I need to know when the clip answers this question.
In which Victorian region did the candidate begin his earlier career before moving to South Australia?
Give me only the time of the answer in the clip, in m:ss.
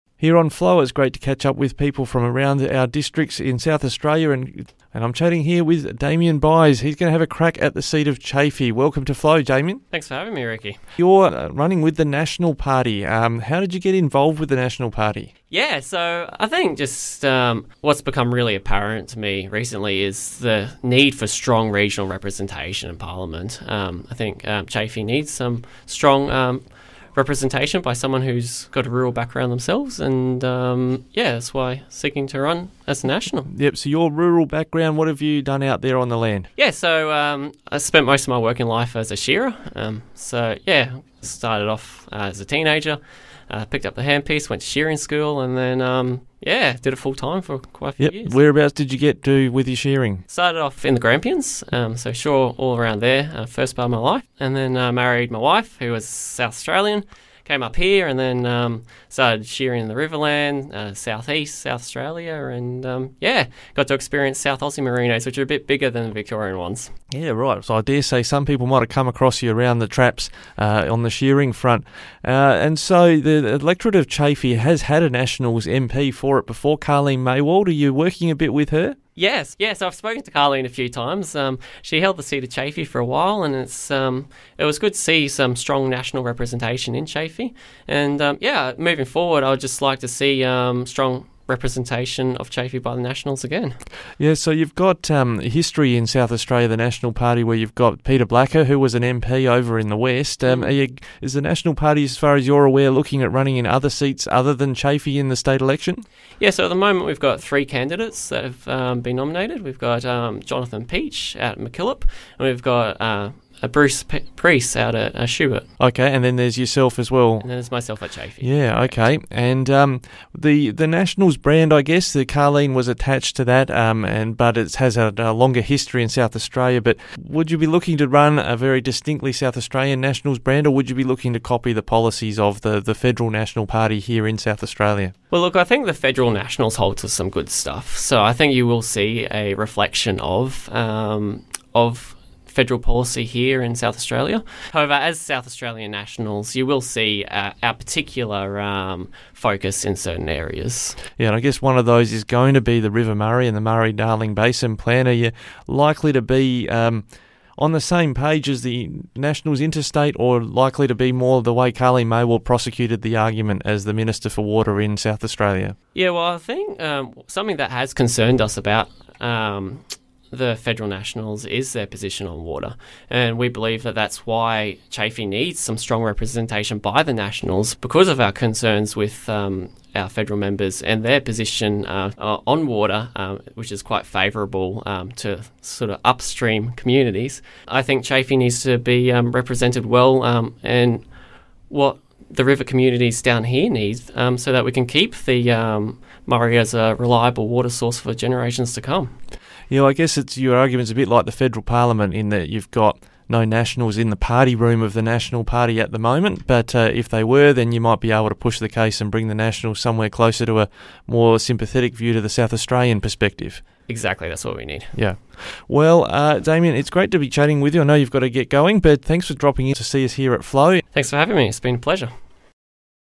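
0:50.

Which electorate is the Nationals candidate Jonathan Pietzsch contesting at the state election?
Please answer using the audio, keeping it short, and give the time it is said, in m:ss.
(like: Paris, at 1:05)
MacKillop, at 1:51.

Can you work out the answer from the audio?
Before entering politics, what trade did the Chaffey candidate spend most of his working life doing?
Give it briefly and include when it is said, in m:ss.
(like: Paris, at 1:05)
Shearer, at 0:39.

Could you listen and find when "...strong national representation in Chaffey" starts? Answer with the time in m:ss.
1:25.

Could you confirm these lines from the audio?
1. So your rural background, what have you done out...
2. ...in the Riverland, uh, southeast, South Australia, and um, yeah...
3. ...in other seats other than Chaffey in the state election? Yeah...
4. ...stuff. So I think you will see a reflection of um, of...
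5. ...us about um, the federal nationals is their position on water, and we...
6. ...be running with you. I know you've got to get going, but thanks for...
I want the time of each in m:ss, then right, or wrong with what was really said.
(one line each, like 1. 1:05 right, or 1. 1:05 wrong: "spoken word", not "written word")
1. 0:33 right
2. 0:59 right
3. 1:43 right
4. 2:17 right
5. 2:48 right
6. 3:37 wrong: "chatting", not "running".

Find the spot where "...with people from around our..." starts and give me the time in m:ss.
0:01.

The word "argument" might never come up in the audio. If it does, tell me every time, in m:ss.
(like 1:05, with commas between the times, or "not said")
2:43, 3:20.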